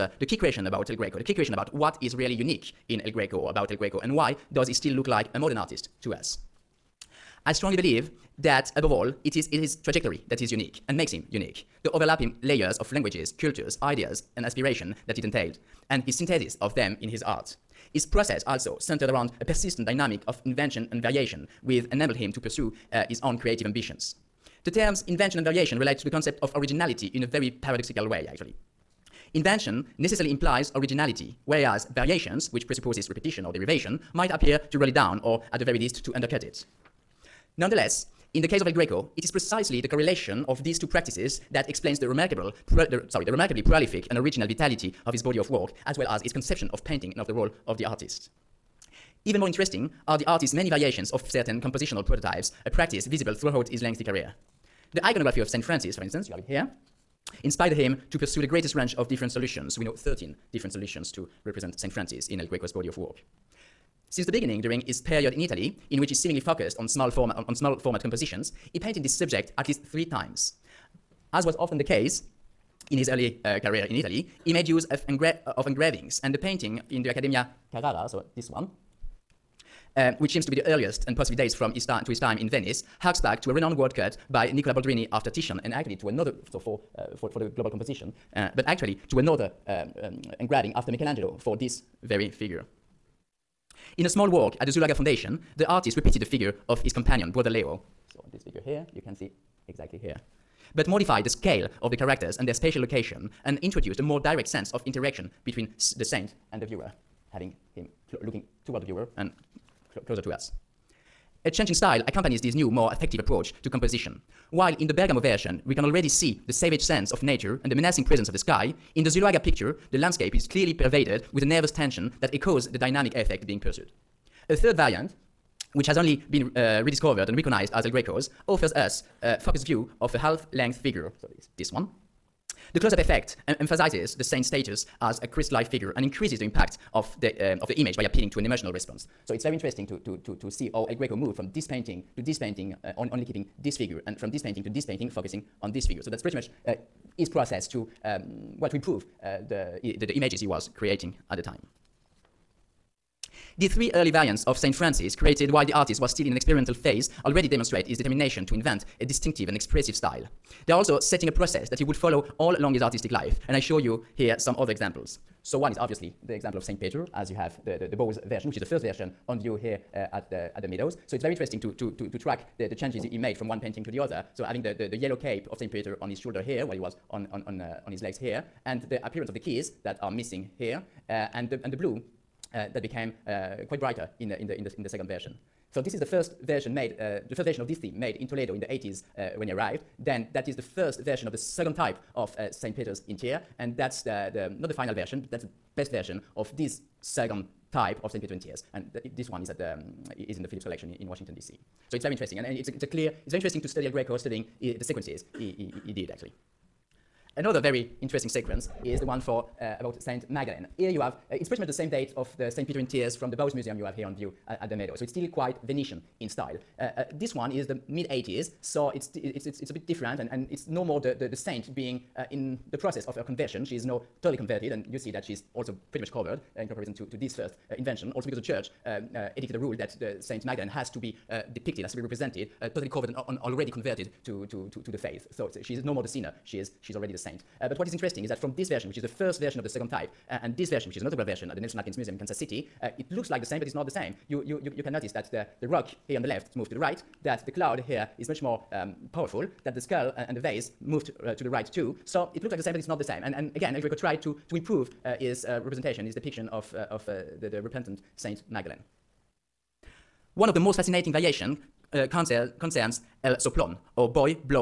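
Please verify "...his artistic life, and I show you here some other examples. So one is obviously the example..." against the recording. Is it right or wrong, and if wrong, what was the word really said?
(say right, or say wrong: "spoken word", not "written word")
right.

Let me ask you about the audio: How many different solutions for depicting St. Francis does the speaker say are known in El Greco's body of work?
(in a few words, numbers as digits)
13.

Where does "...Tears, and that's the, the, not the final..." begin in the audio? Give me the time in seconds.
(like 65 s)
193 s.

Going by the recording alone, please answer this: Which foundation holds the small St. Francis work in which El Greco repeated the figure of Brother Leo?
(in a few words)
Zuloaga Foundation.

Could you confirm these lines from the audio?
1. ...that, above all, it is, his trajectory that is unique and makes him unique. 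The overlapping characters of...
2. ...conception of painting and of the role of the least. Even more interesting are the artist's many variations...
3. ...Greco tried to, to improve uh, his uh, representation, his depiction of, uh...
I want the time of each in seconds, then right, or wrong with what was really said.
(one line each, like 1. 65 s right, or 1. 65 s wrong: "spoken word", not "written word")
1. 8 s wrong: "layers", not "characters"
2. 46 s wrong: "artist", not "least"
3. 253 s right.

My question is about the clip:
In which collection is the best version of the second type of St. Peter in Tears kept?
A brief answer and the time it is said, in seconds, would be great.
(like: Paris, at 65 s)
Phillips collection, at 200 s.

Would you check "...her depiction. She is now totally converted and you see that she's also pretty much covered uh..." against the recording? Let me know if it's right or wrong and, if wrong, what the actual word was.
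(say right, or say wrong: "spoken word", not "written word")
wrong: "conversion", not "depiction".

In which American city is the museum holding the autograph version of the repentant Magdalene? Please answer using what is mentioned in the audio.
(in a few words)
Kansas City.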